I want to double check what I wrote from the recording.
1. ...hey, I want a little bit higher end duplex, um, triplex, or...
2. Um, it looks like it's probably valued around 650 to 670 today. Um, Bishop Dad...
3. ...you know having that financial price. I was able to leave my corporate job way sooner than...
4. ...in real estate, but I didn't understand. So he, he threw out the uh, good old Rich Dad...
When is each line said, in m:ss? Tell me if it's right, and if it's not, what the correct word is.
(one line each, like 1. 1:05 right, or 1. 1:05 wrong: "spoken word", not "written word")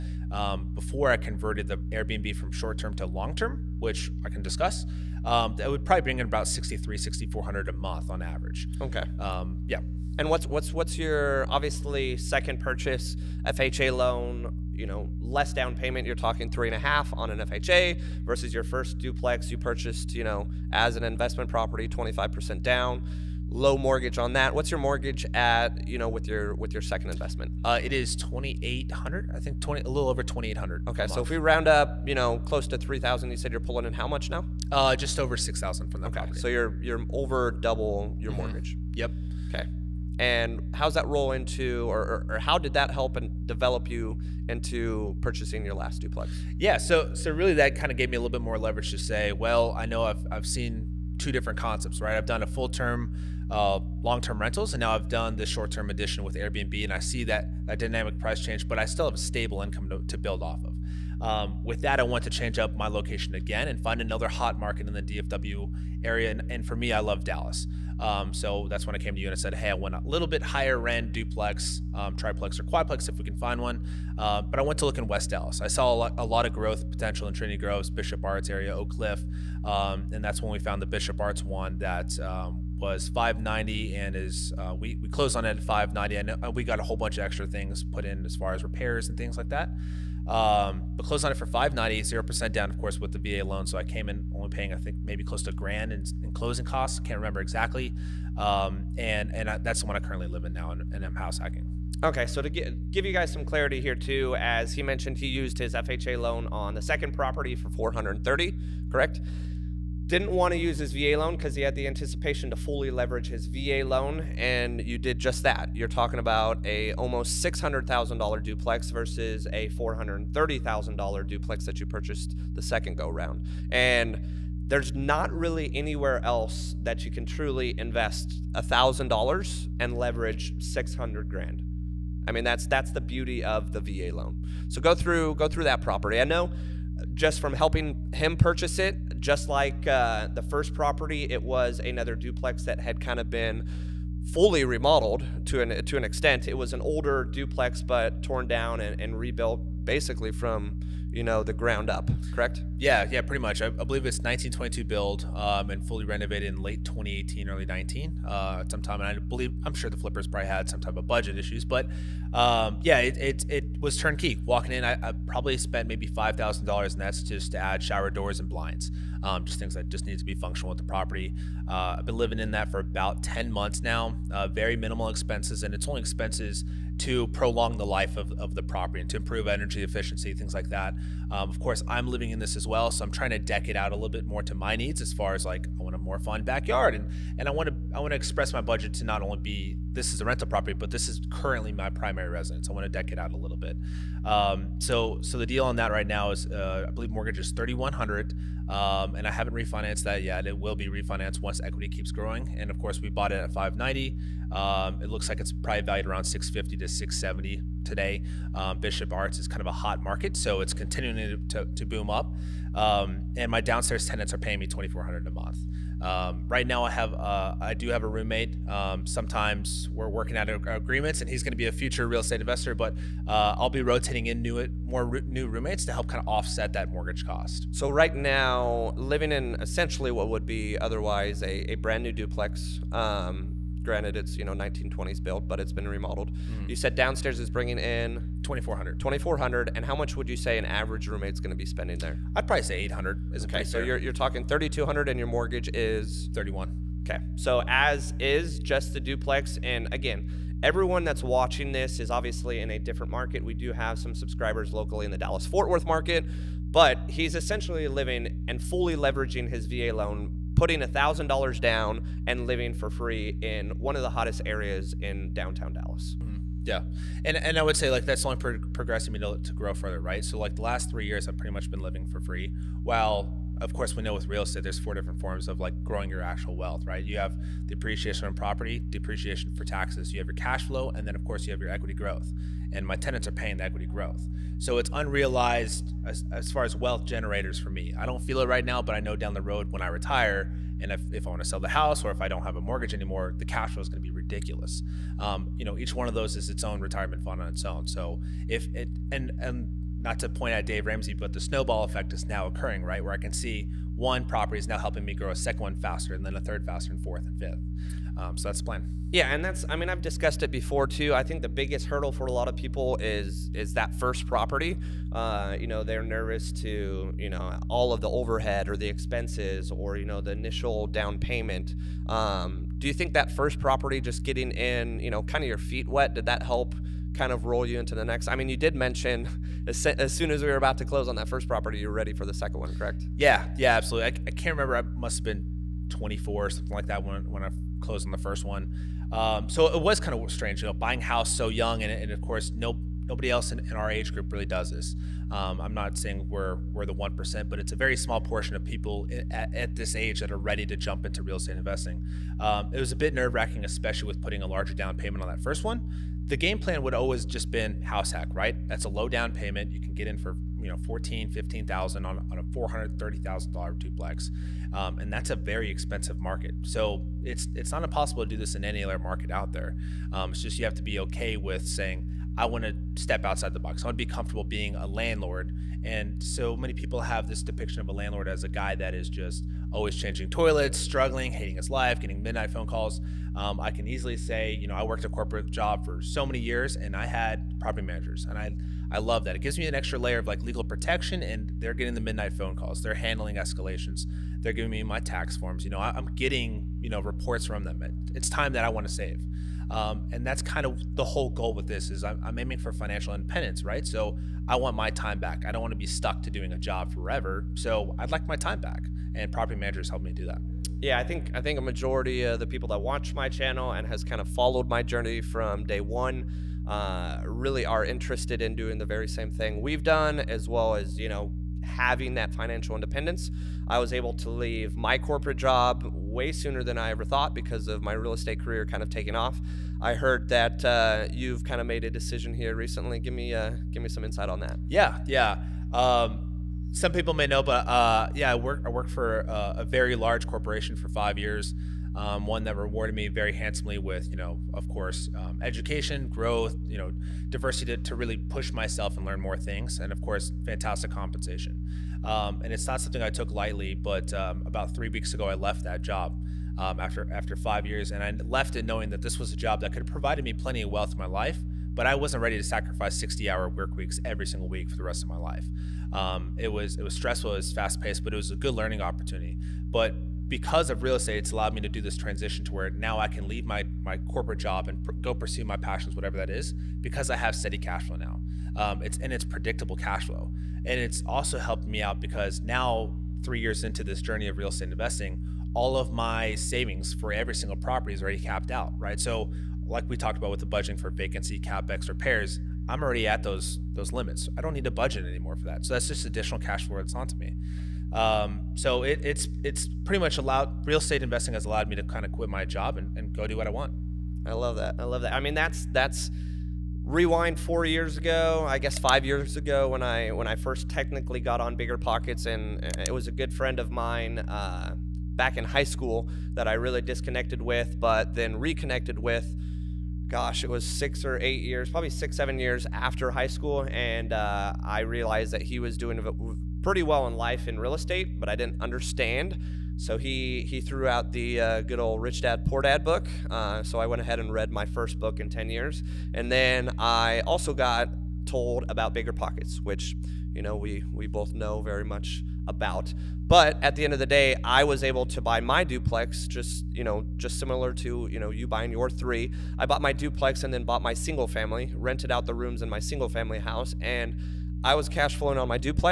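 1. 1:09 right
2. 3:24 wrong: "Arts", not "Dad"
3. 7:00 wrong: "independence", not "price"
4. 8:47 right.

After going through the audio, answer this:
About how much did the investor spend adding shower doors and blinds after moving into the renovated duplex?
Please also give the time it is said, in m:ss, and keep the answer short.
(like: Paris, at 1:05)
$5,000, at 2:46.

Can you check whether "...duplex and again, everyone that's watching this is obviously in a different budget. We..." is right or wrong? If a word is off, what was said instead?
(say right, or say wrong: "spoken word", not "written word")
wrong: "market", not "budget".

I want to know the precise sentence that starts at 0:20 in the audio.
You know, as an investment property, 25% down low mortgage on that.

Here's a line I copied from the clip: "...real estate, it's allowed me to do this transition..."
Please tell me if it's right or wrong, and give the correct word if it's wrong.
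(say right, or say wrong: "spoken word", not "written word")
right.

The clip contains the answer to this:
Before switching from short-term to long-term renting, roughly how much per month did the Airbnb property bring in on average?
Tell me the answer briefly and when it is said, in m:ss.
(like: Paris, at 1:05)
6400, at 0:06.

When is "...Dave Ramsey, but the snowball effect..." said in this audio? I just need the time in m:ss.
5:00.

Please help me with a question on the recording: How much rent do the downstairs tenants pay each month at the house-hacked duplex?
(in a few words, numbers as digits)
2400.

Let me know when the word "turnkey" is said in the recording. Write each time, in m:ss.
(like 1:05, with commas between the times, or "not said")
2:43.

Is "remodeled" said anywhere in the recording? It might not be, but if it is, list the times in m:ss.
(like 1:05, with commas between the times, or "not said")
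2:24, 3:55.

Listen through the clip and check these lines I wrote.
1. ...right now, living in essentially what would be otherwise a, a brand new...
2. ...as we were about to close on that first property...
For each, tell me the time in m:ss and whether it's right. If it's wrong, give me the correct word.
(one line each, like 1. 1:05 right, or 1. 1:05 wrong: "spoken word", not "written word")
1. 3:47 right
2. 5:30 right.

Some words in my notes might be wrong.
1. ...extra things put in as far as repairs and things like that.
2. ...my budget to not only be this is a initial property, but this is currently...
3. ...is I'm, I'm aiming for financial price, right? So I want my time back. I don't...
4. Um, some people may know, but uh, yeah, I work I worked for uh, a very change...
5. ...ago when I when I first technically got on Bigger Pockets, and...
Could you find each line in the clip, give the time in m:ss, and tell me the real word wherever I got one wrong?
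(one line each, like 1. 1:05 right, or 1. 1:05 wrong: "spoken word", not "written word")
1. 1:27 right
2. 3:08 wrong: "rental", not "initial"
3. 6:41 wrong: "independence", not "price"
4. 7:15 wrong: "large", not "change"
5. 8:29 right.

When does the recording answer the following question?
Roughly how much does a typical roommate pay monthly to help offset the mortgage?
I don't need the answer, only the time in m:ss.
4:02.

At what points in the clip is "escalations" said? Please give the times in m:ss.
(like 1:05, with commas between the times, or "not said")
6:33.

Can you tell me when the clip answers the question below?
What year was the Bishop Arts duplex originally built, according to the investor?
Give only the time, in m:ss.
2:34.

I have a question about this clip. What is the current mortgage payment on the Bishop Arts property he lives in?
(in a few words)
3100.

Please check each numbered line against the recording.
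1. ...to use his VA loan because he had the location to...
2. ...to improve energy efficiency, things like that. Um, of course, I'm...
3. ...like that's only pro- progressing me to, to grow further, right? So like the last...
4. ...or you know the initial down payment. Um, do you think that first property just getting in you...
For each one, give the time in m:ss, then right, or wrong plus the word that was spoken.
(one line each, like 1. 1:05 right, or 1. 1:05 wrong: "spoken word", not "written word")
1. 1:50 wrong: "anticipation", not "location"
2. 2:59 right
3. 4:27 right
4. 5:19 right.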